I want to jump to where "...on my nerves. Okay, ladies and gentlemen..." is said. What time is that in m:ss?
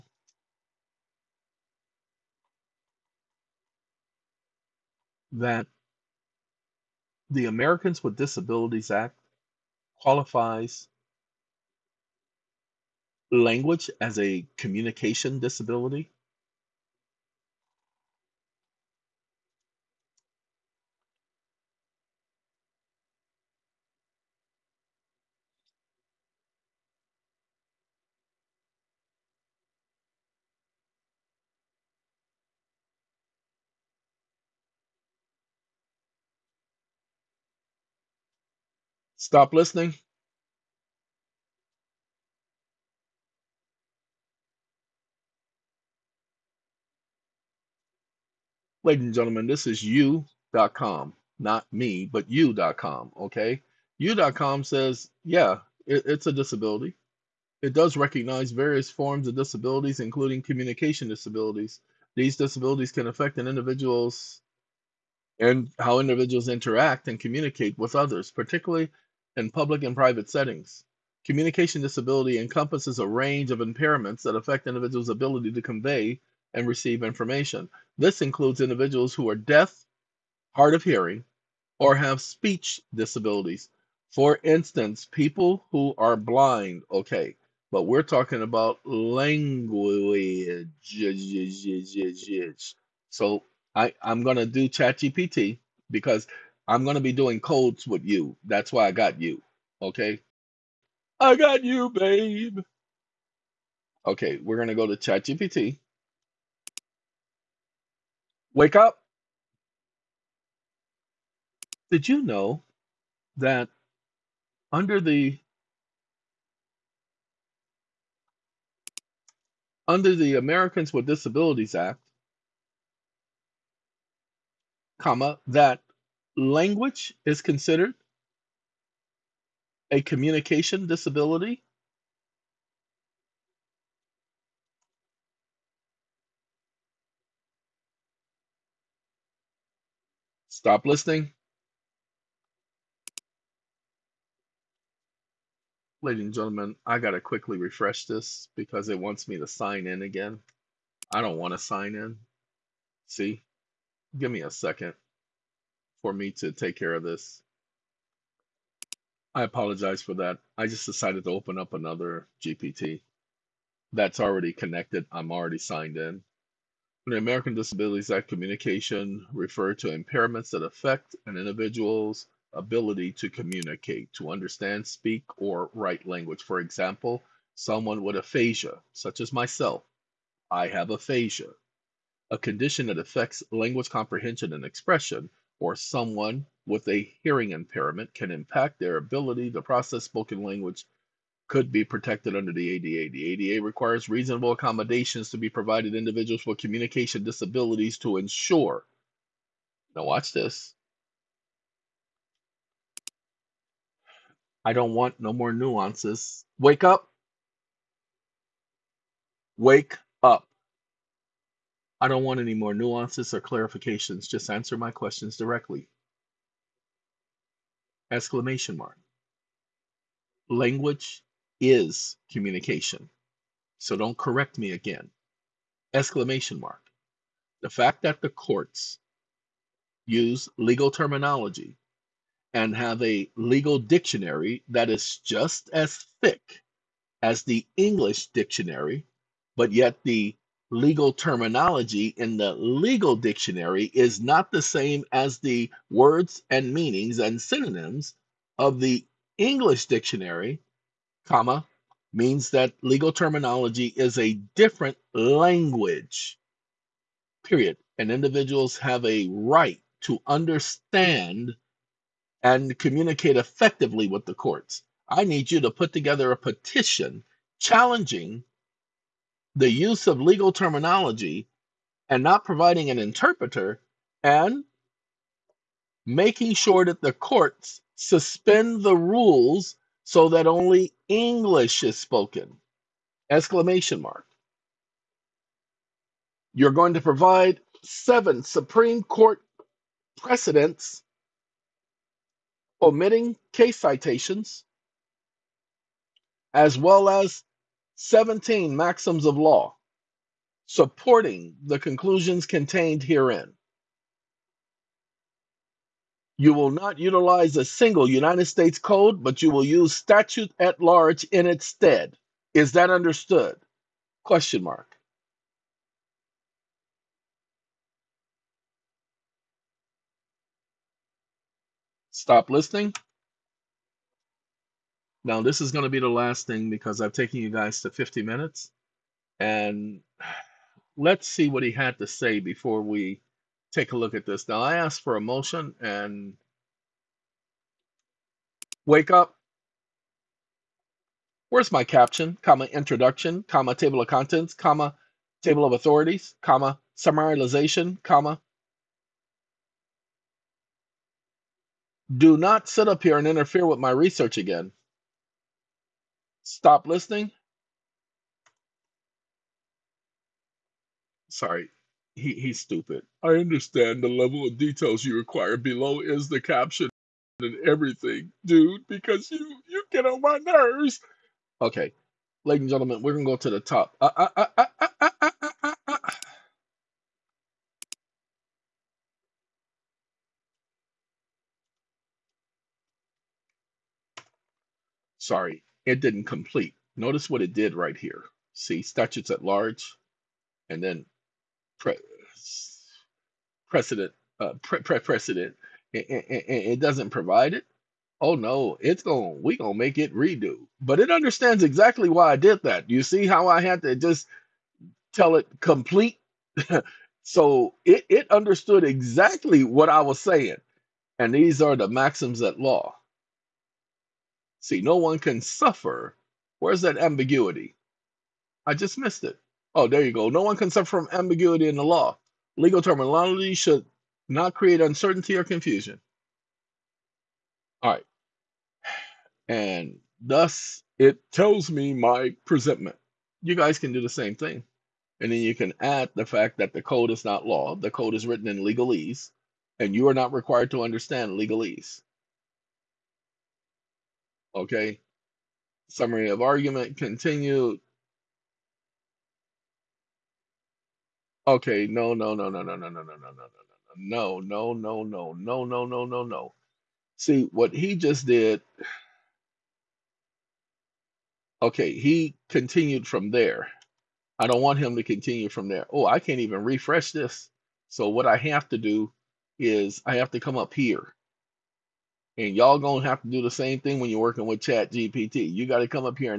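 6:10.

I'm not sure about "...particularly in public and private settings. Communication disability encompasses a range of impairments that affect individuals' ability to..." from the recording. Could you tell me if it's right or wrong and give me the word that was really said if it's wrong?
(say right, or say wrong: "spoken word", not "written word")
right.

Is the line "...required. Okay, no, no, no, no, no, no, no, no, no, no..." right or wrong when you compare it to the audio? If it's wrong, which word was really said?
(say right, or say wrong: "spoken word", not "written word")
wrong: "continued", not "required".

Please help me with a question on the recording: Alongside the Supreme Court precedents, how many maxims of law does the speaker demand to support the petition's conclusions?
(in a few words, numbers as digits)
17.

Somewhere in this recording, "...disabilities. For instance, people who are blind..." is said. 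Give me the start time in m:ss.
1:22.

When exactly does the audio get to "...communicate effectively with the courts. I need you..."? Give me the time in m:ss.
4:22.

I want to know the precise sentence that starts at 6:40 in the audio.
But it understands exactly why I did that.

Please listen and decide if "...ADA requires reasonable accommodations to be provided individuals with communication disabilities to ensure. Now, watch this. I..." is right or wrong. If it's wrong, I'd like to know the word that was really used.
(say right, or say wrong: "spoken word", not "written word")
right.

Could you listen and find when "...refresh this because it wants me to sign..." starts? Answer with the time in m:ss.
2:27.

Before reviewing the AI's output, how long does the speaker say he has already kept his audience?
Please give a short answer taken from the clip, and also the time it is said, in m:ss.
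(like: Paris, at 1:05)
50 minutes, at 5:27.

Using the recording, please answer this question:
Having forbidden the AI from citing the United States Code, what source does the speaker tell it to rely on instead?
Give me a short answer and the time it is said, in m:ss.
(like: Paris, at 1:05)
Statutes at Large, at 5:09.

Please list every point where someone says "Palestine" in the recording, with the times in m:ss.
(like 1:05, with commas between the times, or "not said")
not said.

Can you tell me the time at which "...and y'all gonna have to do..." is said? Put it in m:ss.
7:52.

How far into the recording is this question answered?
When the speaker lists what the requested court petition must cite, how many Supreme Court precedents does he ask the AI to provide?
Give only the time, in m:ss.
4:47.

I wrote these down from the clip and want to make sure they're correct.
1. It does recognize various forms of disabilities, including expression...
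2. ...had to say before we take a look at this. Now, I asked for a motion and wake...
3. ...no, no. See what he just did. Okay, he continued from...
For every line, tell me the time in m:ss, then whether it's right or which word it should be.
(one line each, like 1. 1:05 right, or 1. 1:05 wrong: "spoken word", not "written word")
1. 0:57 wrong: "communication", not "expression"
2. 5:31 right
3. 7:36 right.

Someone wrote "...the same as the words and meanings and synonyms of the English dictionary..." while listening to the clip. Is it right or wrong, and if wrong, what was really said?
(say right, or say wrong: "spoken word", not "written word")
right.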